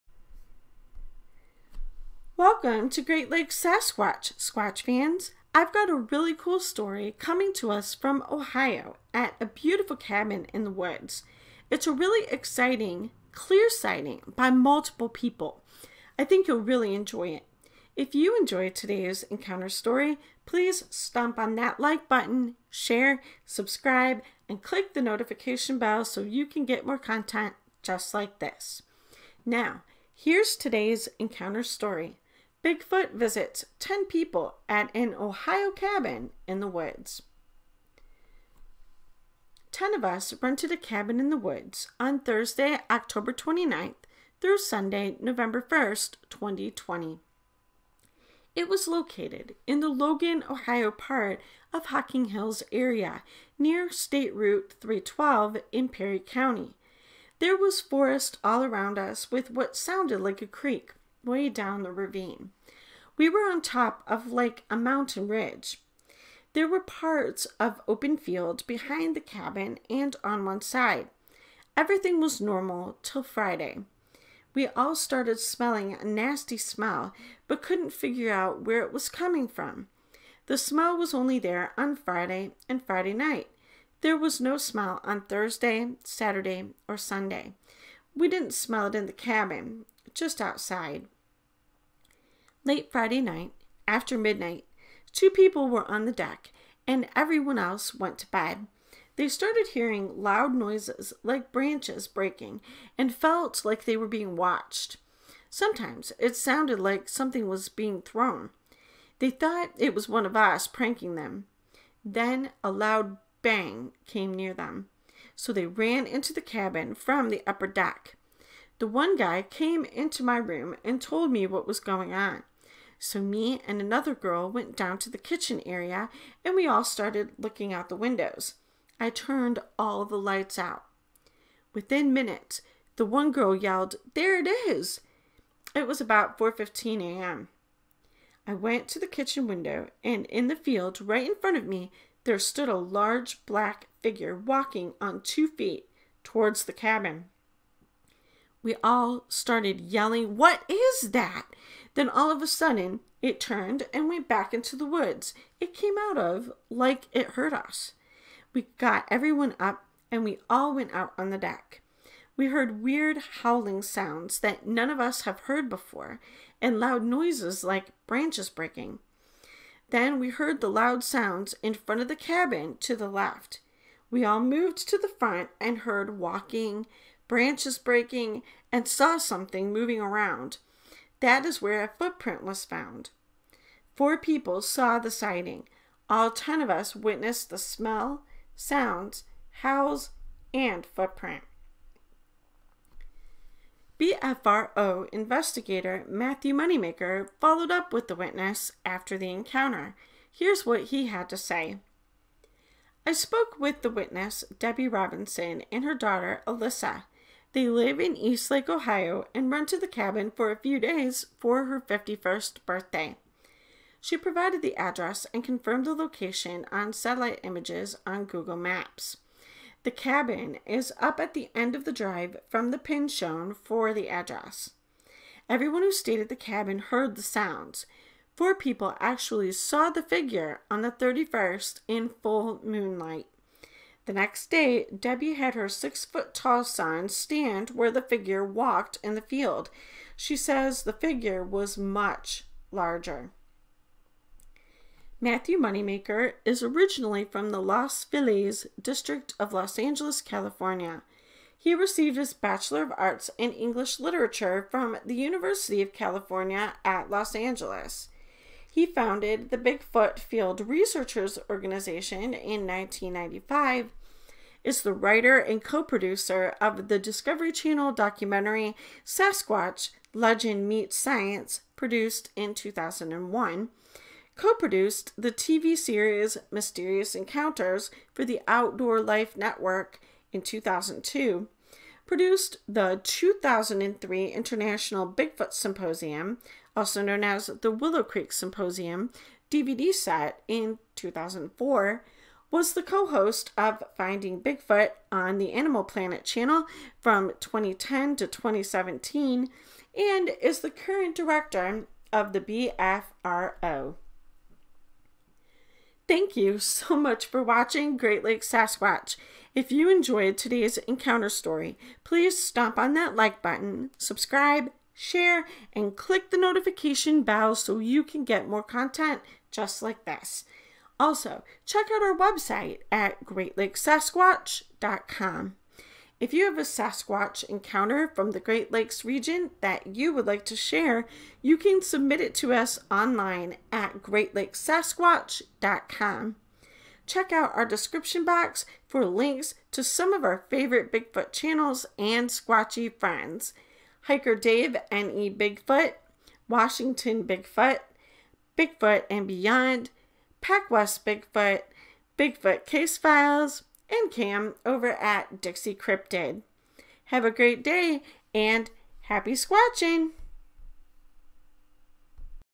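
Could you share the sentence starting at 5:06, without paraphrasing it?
Thank you so much for watching Great Lakes Sasquatch.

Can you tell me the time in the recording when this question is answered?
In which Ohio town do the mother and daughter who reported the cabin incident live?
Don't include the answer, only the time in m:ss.
3:28.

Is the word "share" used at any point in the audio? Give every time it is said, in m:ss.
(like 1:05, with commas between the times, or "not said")
0:22, 5:14, 5:30.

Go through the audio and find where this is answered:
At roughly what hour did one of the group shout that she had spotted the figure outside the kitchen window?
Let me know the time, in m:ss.
2:16.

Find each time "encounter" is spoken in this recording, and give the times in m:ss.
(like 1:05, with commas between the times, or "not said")
0:19, 0:31, 3:19, 4:37, 5:10, 5:27.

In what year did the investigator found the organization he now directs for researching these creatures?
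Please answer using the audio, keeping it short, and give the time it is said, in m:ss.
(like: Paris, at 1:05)
1995, at 4:22.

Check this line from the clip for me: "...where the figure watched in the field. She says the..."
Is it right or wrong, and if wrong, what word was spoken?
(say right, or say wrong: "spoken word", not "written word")
wrong: "walked", not "watched".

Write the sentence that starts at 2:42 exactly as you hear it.
We heard weird howling sounds that none of us have heard before and loud noises like branches breaking.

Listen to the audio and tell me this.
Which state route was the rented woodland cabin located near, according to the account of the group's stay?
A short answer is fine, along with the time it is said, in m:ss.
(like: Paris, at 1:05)
State Route 312, at 0:53.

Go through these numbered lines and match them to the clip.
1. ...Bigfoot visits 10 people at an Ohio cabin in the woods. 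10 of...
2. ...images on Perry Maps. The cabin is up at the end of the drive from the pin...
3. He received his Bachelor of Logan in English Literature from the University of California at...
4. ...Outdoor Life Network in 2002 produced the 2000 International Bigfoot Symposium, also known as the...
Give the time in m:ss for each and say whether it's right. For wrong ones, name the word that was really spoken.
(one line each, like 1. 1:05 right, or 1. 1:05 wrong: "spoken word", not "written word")
1. 0:32 right
2. 3:37 wrong: "Google", not "Perry"
3. 4:11 wrong: "Arts", not "Logan"
4. 4:38 wrong: "2003", not "2000".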